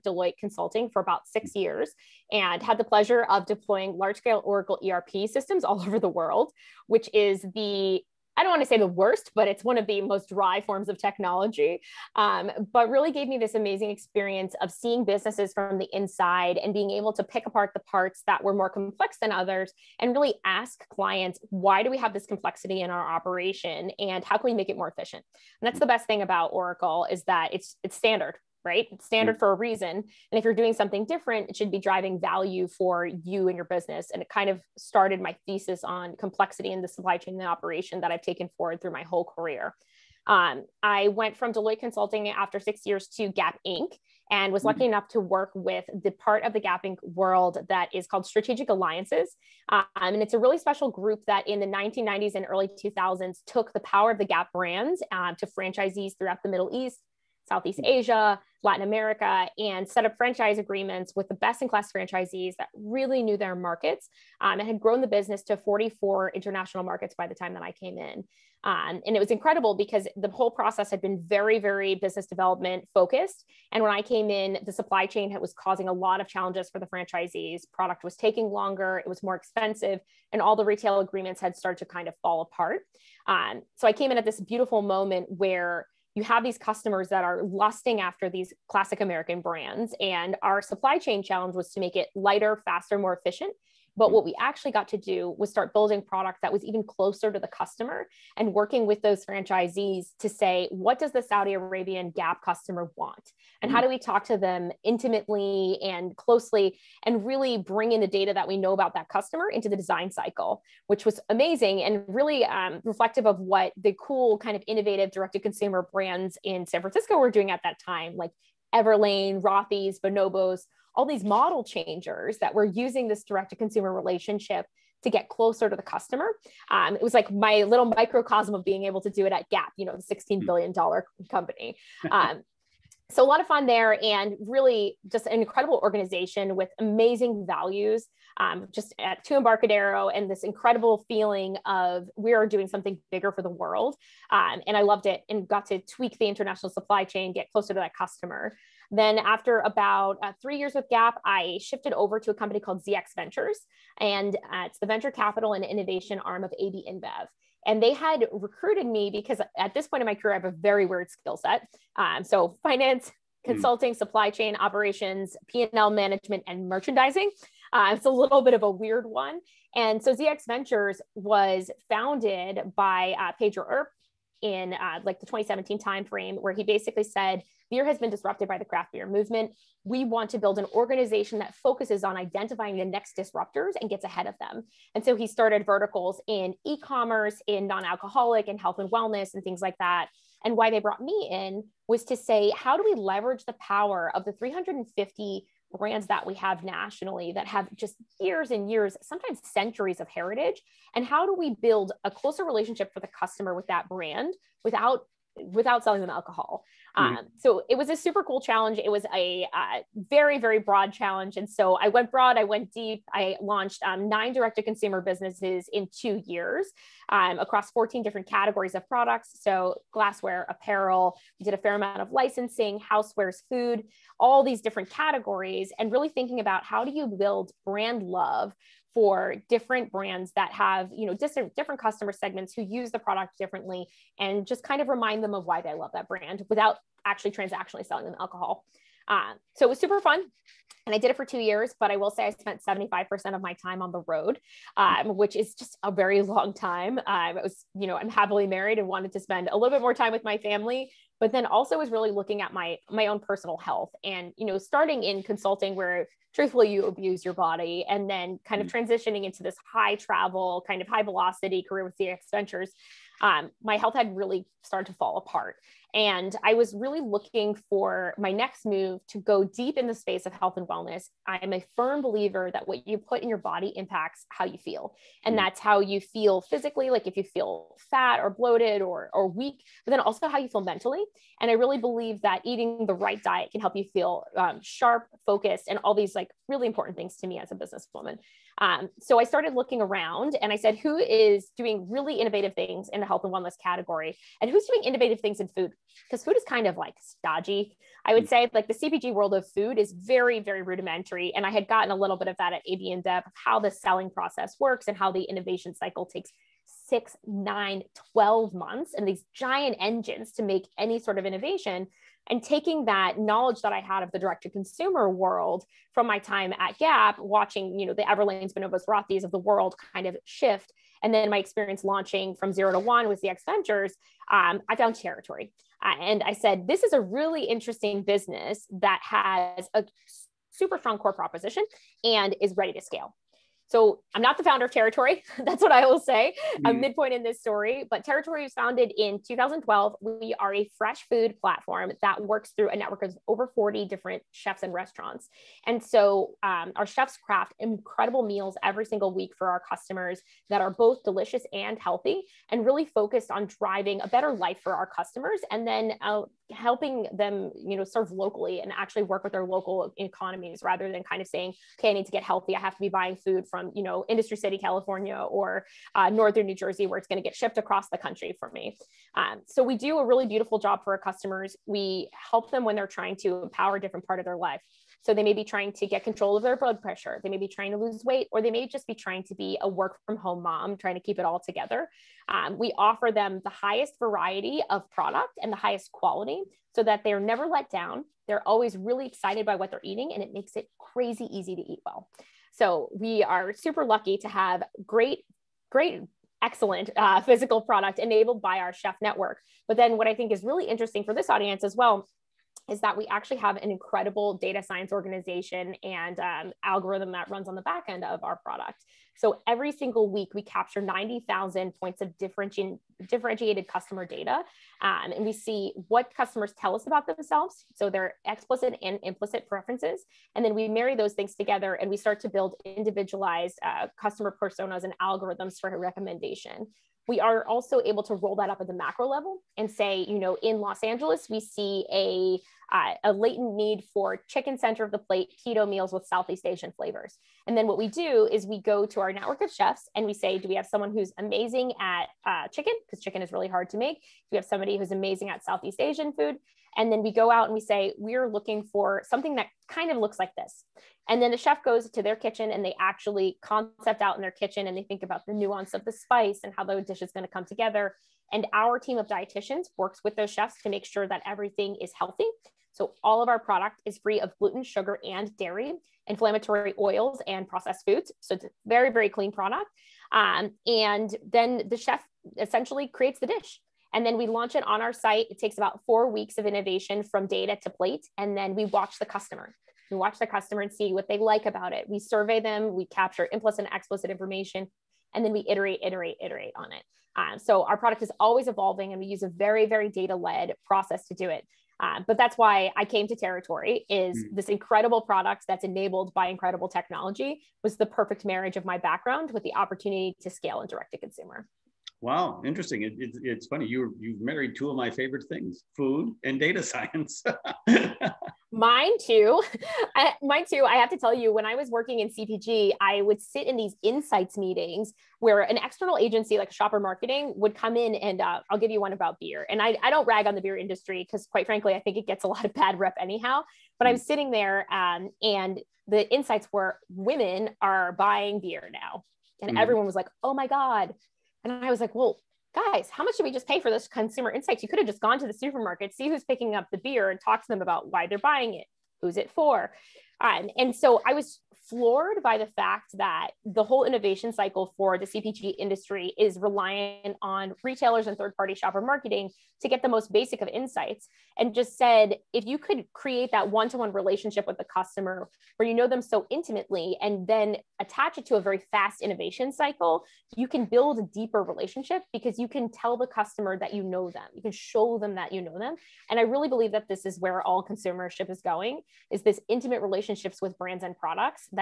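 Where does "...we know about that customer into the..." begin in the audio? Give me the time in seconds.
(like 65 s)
108 s.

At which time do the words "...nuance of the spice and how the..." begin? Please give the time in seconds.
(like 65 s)
455 s.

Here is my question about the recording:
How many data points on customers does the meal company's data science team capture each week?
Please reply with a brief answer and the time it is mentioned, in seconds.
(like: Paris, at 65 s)
90,000, at 410 s.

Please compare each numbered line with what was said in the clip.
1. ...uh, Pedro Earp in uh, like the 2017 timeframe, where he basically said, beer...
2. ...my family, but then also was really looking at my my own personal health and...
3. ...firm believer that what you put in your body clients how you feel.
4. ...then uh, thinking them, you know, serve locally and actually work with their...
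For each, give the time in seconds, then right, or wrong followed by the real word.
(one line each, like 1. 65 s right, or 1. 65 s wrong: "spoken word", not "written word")
1. 173 s right
2. 250 s right
3. 271 s wrong: "impacts", not "clients"
4. 355 s wrong: "helping", not "thinking".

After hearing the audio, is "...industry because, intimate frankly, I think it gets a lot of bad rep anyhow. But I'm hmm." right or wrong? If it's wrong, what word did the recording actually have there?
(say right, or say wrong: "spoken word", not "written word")
wrong: "quite", not "intimate".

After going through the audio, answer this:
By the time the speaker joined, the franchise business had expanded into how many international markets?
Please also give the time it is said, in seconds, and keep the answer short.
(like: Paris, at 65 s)
44, at 65 s.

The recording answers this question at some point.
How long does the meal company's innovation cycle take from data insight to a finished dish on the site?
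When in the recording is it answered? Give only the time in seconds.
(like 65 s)
475 s.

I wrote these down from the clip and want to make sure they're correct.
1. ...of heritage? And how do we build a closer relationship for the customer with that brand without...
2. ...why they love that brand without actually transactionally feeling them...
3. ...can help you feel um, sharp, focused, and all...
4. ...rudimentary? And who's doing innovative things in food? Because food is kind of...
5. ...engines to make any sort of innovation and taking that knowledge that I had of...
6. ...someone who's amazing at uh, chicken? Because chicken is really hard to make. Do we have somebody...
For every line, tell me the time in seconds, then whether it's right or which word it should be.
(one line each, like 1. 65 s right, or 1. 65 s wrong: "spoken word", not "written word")
1. 199 s right
2. 235 s wrong: "selling", not "feeling"
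3. 283 s right
4. 293 s wrong: "category", not "rudimentary"
5. 309 s right
6. 440 s right.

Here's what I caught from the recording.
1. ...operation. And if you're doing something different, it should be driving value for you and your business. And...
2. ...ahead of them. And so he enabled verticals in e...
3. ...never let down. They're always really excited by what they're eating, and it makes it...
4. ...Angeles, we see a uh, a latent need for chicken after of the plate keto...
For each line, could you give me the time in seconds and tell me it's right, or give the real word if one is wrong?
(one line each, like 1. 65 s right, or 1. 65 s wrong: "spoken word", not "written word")
1. 29 s wrong: "reason", not "operation"
2. 184 s wrong: "started", not "enabled"
3. 387 s right
4. 430 s wrong: "center", not "after".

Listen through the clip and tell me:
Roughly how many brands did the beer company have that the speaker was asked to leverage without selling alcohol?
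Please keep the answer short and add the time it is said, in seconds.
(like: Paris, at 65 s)
350, at 194 s.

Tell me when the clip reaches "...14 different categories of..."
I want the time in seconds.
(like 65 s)
217 s.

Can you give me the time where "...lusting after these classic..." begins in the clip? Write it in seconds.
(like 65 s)
87 s.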